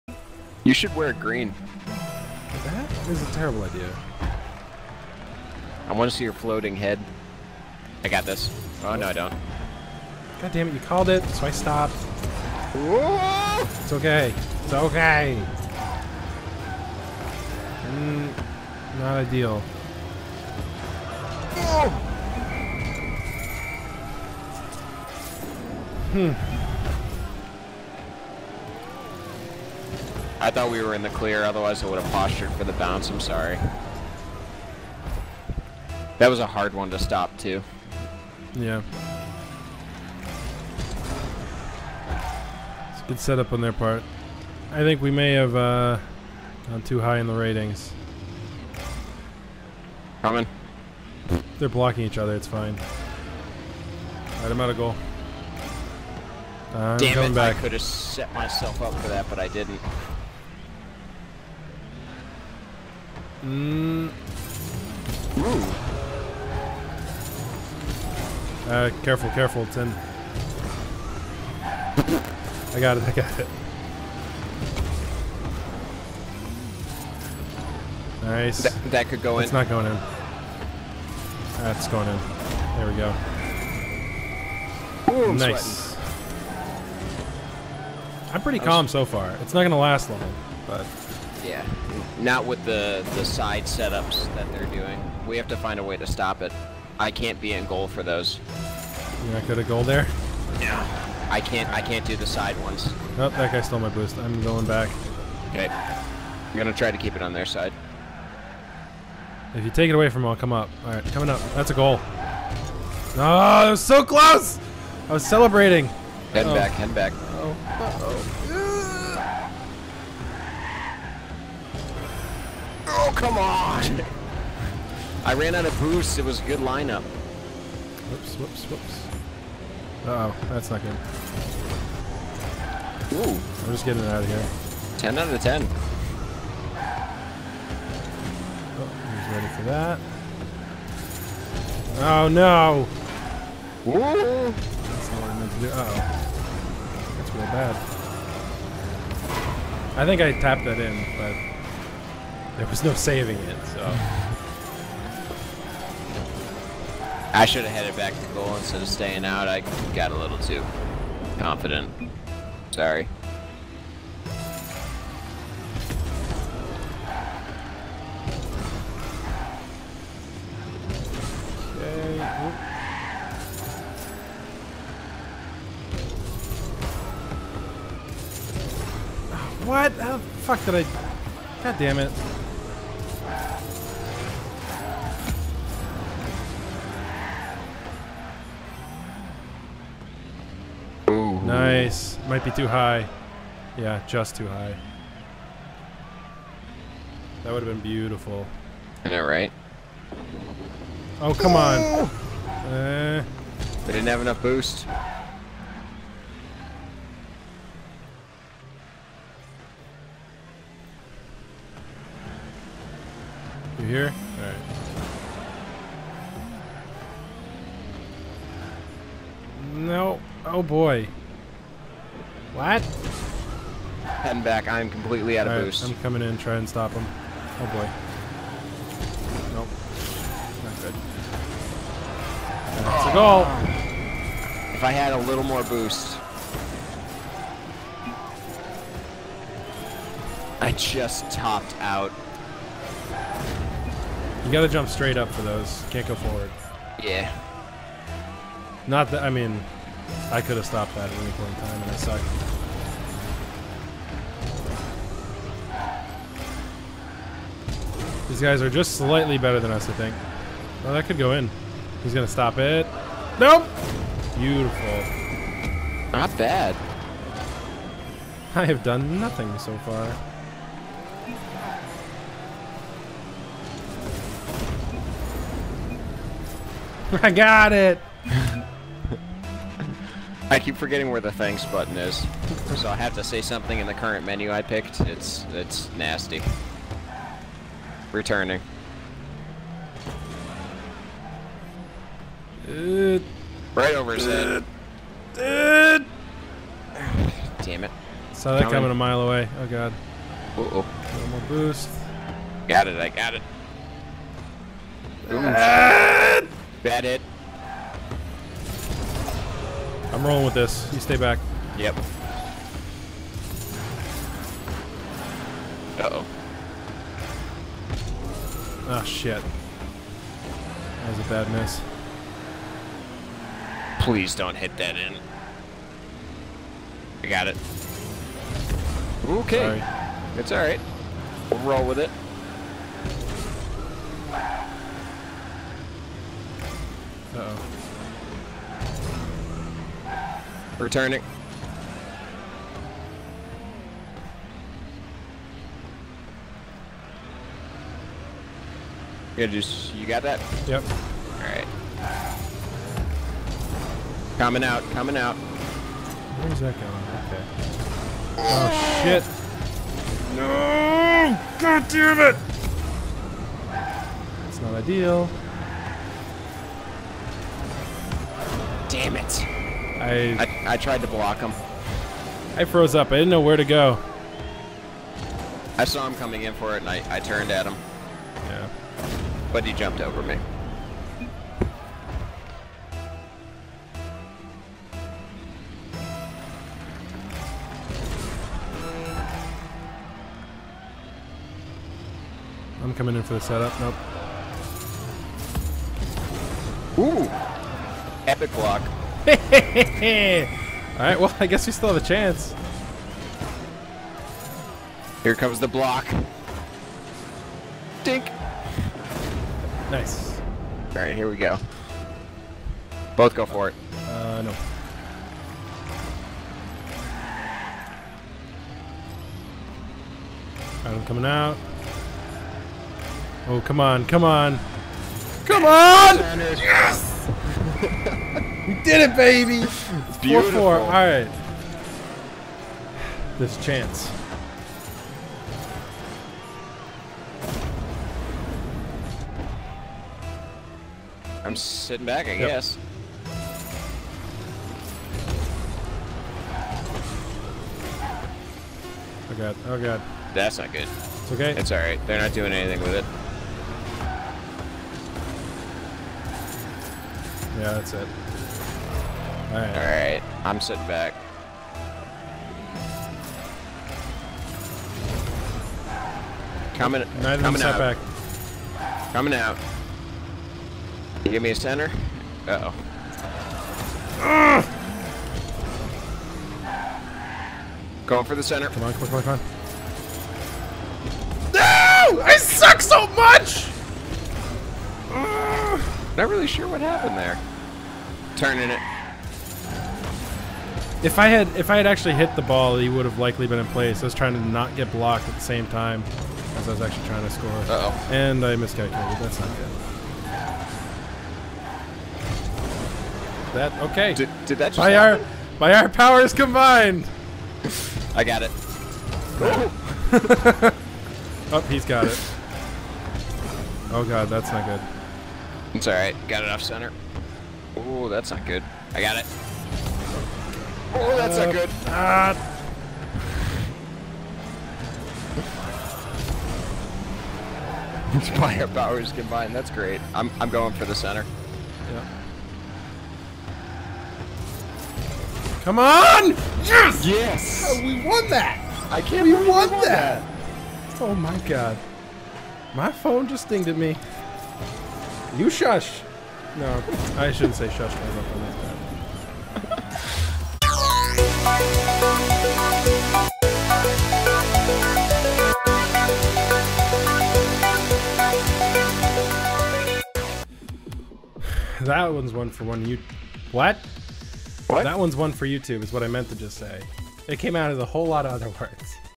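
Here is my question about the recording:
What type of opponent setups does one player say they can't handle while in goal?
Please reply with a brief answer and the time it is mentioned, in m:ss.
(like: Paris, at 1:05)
Side setups, at 1:42.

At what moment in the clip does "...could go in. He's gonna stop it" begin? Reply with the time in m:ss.
4:21.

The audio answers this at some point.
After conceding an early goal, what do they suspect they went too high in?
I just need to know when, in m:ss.
0:47.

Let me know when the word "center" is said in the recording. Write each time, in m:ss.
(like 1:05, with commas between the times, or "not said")
7:51, 7:58, 8:36, 8:50.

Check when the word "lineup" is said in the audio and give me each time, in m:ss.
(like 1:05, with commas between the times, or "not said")
2:06.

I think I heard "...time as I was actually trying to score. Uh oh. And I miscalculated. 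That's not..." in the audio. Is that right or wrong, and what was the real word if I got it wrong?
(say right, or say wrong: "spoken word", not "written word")
right.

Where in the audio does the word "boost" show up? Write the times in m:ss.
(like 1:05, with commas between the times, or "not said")
1:43, 2:05, 3:24, 3:45, 3:55, 5:01.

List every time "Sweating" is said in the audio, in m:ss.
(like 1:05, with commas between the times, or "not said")
1:25.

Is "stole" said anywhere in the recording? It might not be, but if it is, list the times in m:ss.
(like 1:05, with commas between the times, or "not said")
1:43.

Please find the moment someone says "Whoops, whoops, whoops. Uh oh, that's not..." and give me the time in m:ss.
2:08.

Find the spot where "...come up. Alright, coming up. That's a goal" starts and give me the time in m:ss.
1:50.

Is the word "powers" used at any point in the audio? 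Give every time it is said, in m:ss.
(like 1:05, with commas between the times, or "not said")
8:25, 8:48.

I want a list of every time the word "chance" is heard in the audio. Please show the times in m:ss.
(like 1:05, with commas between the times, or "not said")
6:42, 7:13.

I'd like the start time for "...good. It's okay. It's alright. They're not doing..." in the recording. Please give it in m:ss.
7:30.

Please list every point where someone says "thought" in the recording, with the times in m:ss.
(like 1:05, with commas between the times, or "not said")
0:30.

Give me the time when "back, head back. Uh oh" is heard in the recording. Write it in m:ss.
1:56.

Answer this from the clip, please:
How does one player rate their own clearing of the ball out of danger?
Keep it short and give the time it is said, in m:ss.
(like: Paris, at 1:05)
10 out of 10, at 2:14.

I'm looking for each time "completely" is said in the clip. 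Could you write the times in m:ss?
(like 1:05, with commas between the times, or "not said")
3:44.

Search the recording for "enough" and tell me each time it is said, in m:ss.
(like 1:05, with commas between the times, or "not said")
3:24.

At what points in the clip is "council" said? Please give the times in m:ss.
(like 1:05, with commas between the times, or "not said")
not said.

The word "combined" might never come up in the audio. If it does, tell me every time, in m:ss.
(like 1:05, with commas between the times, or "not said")
8:26, 8:49.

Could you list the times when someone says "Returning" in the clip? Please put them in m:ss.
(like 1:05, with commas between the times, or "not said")
4:48, 5:40.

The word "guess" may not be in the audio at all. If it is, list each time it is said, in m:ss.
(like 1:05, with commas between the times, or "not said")
6:41, 7:22.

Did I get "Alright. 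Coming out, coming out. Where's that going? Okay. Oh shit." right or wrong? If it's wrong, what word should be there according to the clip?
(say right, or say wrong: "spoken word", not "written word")
right.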